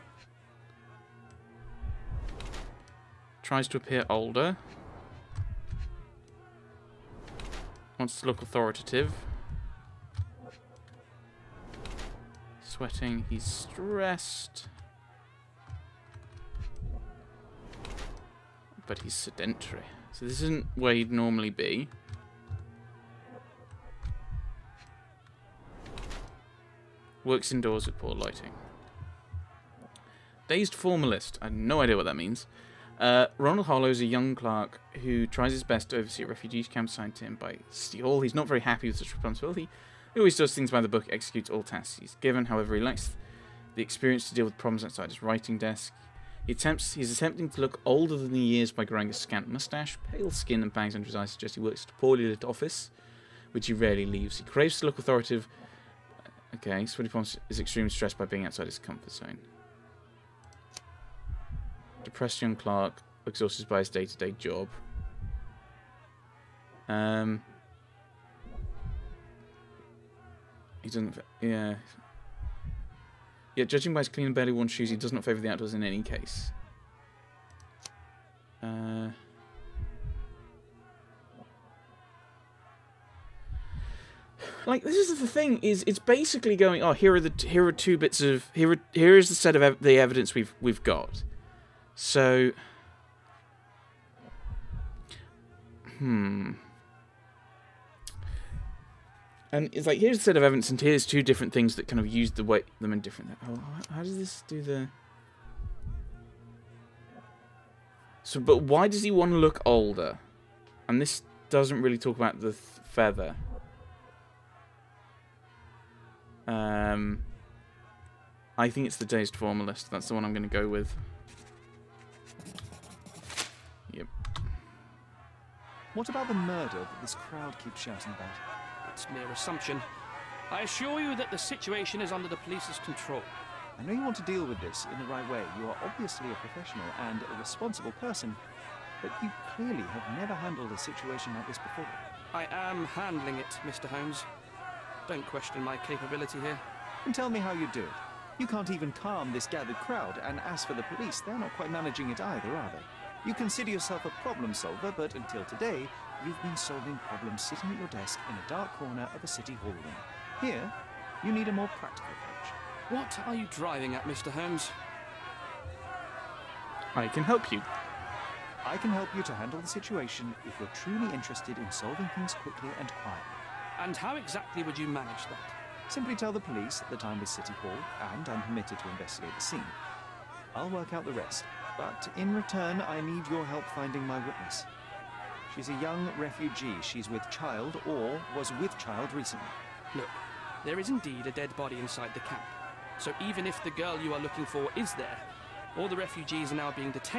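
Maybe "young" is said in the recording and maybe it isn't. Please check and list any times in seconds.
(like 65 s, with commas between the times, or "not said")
34 s, 62 s, 185 s.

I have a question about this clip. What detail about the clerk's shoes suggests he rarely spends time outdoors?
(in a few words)
Clean and barely worn.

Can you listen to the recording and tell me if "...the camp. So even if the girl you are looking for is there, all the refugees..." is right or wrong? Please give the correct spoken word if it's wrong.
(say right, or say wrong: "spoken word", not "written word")
right.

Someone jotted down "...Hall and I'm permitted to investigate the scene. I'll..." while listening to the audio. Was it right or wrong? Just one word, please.
right.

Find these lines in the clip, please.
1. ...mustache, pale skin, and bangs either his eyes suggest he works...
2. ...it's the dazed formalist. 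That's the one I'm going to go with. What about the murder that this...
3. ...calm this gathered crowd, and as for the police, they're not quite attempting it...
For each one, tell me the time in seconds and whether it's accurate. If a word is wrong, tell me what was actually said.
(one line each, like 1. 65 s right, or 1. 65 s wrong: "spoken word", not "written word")
1. 49 s wrong: "under", not "either"
2. 118 s right
3. 148 s wrong: "managing", not "attempting".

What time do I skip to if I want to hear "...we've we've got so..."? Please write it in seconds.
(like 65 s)
90 s.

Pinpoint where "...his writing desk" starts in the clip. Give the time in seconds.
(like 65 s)
45 s.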